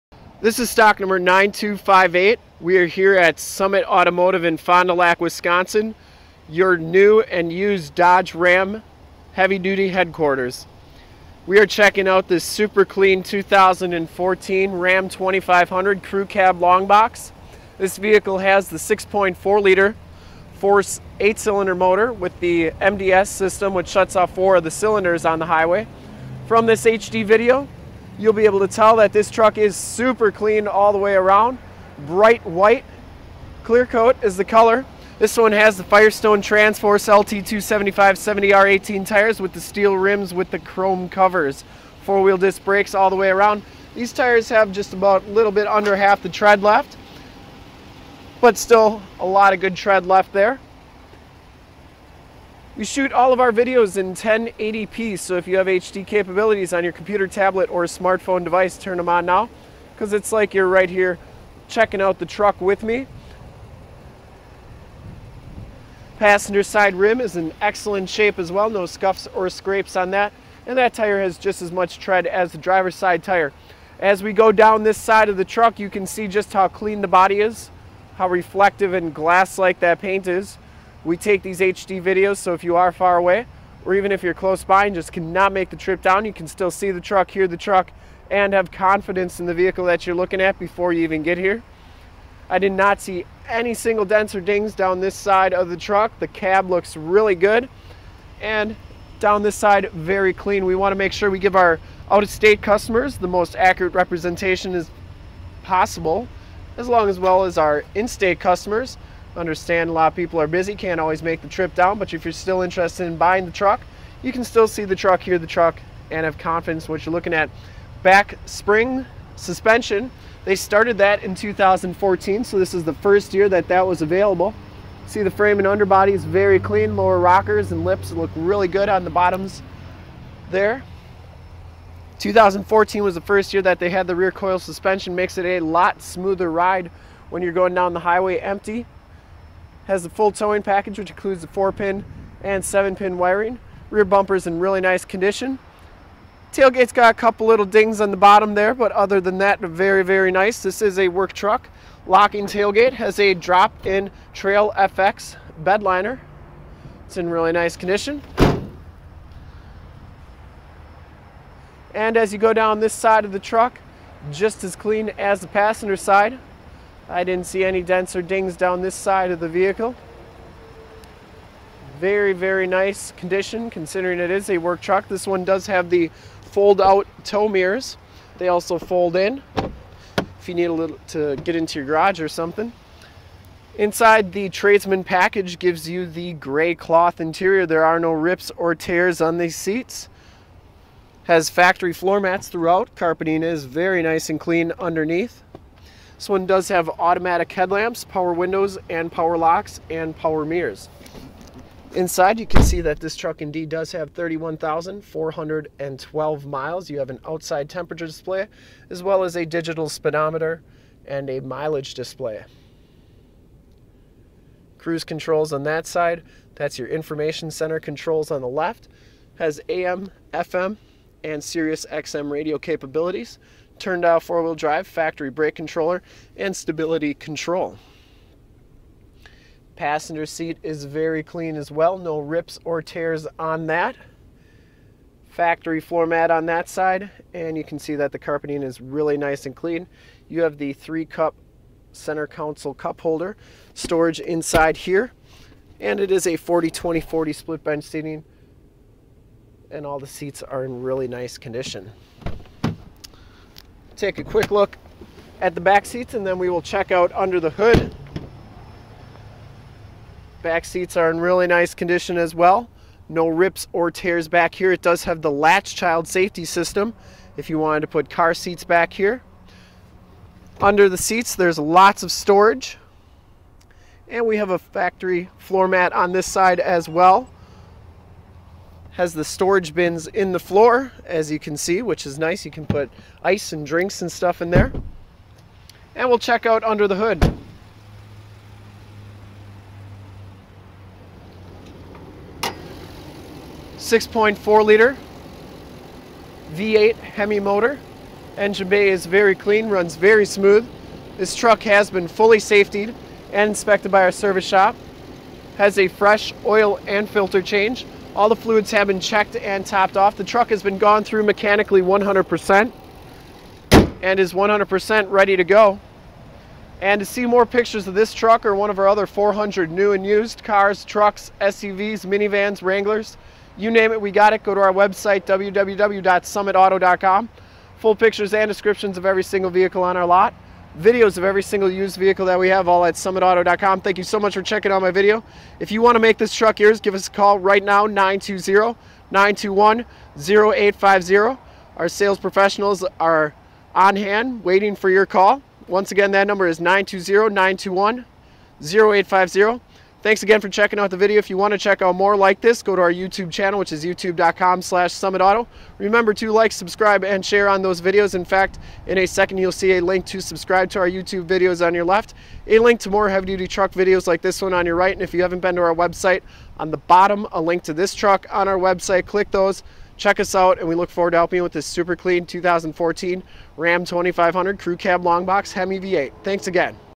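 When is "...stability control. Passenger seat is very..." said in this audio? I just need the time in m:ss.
3:46.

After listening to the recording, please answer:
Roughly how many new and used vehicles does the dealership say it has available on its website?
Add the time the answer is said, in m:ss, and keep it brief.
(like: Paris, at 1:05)
400, at 5:19.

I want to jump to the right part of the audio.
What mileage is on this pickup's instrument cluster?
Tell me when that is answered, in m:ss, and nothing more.
3:24.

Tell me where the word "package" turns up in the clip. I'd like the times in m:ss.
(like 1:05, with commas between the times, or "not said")
2:20, 3:05.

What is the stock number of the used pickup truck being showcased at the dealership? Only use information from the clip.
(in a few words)
9258.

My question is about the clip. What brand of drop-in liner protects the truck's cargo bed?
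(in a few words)
Trail FX.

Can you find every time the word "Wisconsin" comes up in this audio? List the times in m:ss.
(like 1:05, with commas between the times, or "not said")
0:05.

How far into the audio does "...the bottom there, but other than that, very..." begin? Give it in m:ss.
2:28.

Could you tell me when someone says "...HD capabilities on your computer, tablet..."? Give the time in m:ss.
0:55.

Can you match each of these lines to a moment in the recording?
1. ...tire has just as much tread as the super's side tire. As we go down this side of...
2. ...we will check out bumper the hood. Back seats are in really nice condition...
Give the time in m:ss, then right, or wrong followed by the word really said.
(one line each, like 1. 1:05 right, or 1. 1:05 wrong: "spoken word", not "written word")
1. 1:10 wrong: "driver", not "super"
2. 4:16 wrong: "under", not "bumper".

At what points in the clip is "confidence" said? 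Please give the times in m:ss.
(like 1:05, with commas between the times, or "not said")
1:28, 1:56.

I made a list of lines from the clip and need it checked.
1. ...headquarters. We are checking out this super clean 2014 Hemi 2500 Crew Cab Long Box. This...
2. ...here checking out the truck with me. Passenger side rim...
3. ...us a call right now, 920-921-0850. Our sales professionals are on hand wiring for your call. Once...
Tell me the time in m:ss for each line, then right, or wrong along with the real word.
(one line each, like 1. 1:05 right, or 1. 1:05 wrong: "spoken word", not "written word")
1. 0:09 wrong: "Ram", not "Hemi"
2. 1:00 right
3. 5:36 wrong: "waiting", not "wiring".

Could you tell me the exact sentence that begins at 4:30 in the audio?
Under the seats, there's lots of storage.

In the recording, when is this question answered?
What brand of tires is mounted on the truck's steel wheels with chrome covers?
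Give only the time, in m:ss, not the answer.
0:35.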